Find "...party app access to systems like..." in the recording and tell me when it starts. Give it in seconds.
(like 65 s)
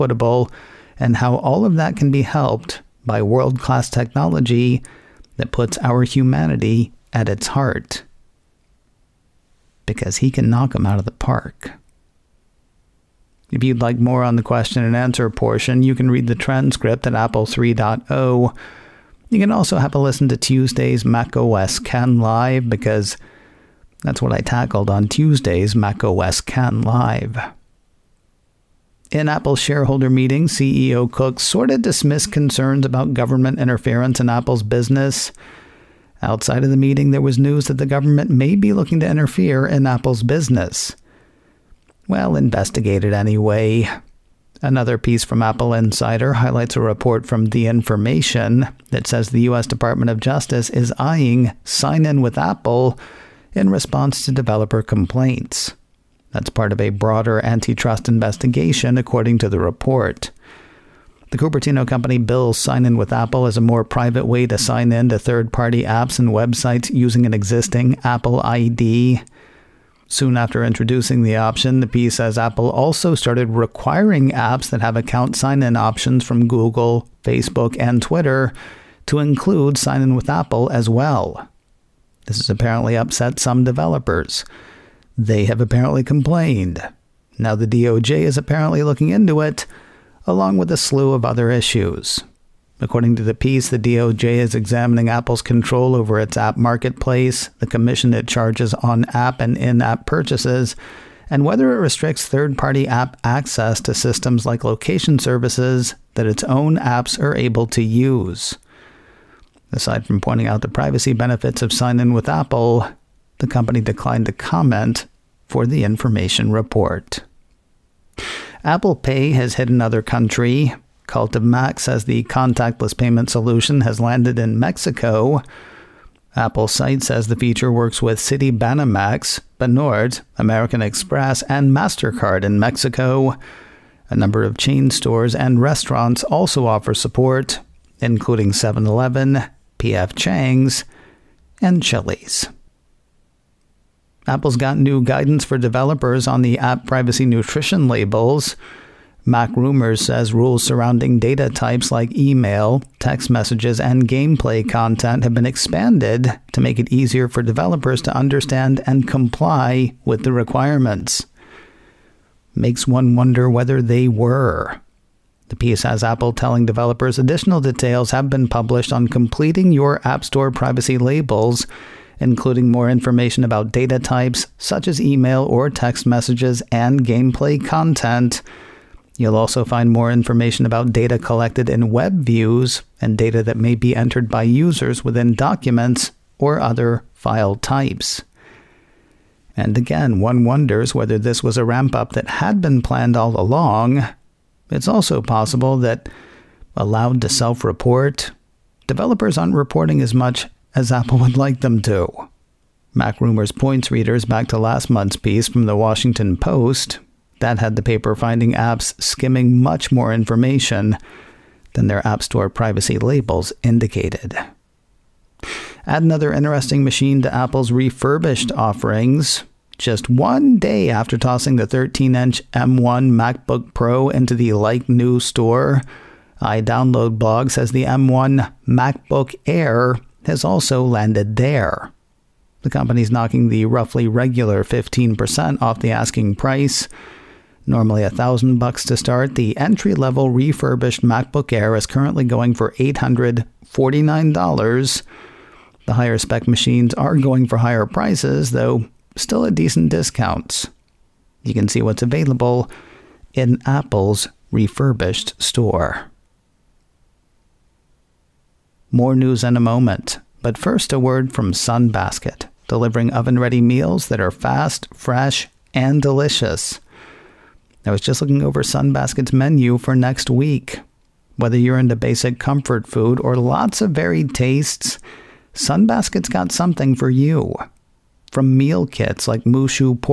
102 s.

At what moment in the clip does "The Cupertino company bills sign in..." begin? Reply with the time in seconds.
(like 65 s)
61 s.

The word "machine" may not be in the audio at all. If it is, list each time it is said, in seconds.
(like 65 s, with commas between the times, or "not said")
216 s, 246 s.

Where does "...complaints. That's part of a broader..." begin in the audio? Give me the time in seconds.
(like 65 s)
54 s.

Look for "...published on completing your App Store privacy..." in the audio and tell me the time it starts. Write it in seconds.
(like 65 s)
168 s.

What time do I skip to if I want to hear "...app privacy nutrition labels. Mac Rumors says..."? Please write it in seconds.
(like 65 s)
146 s.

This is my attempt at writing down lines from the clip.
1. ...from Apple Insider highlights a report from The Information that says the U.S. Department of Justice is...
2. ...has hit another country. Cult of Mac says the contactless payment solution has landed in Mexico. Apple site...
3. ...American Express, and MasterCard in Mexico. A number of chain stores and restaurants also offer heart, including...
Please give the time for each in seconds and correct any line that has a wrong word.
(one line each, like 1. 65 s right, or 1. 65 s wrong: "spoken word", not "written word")
1. 45 s right
2. 119 s right
3. 130 s wrong: "support", not "heart".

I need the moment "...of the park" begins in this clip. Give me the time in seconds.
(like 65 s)
10 s.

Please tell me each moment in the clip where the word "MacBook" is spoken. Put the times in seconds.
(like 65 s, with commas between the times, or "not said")
223 s, 228 s, 241 s.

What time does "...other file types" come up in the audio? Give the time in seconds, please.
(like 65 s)
186 s.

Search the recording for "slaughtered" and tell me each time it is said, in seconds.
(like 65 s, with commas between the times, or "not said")
not said.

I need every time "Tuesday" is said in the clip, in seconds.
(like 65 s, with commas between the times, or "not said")
20 s, 25 s.